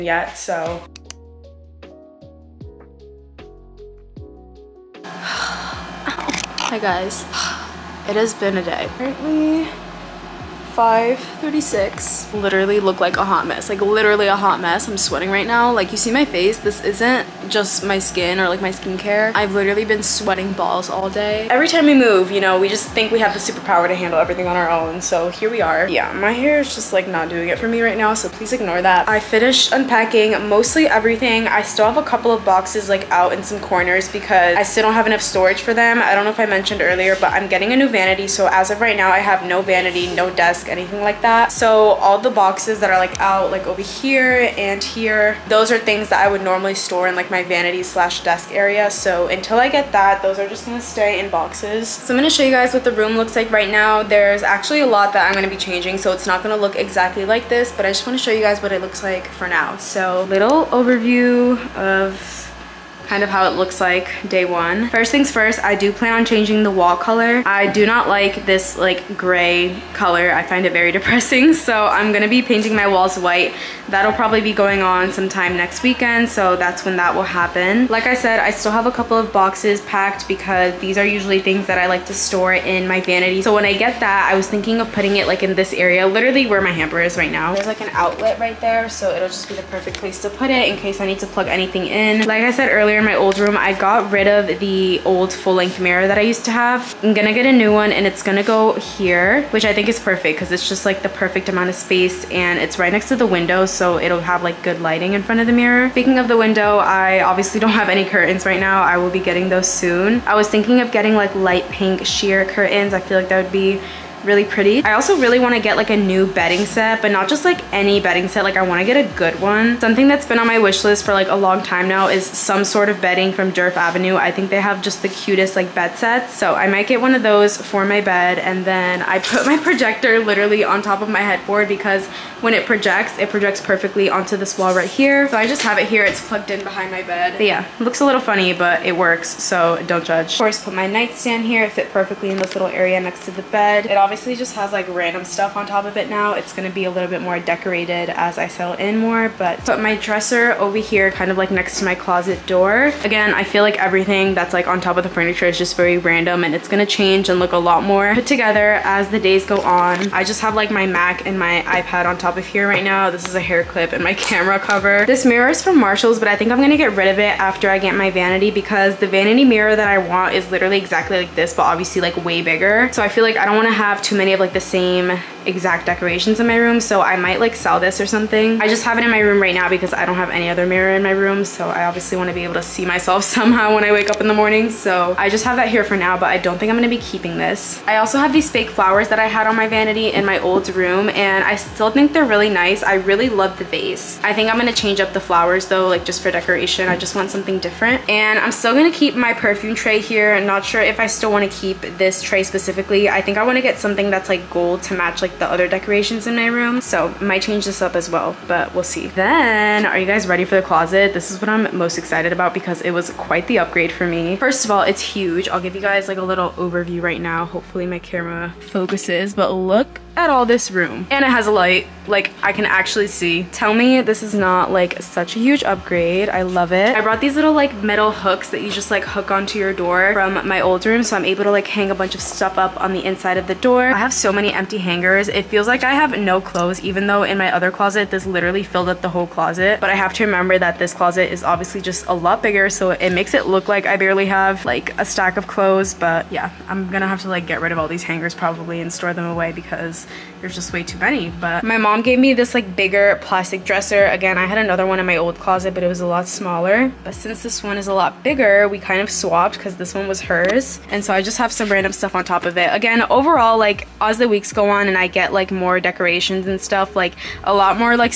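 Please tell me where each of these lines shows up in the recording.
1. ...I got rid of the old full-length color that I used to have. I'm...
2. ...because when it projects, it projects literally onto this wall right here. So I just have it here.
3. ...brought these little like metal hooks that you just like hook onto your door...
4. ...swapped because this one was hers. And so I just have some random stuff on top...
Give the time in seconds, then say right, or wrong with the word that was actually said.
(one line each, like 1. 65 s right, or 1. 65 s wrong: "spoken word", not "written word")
1. 93 s wrong: "mirror", not "color"
2. 131 s wrong: "perfectly", not "literally"
3. 227 s right
4. 259 s right.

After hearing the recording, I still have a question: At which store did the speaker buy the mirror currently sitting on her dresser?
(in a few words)
Marshalls.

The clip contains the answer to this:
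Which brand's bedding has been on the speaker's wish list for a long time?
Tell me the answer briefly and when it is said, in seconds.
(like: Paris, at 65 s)
Durf Avenue, at 123 s.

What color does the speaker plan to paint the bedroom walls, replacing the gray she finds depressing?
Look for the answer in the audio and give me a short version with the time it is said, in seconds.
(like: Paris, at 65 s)
White, at 72 s.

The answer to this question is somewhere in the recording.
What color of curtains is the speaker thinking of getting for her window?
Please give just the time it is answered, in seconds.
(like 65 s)
111 s.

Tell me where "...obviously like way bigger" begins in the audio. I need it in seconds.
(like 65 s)
171 s.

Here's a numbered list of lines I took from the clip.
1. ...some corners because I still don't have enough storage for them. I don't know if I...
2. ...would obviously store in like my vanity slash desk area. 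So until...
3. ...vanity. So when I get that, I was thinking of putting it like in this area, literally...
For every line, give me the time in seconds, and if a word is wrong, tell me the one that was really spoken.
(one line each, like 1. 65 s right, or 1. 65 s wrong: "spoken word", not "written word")
1. 33 s right
2. 46 s wrong: "normally", not "obviously"
3. 83 s right.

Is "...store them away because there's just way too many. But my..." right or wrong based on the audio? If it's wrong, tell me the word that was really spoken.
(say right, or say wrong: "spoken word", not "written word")
right.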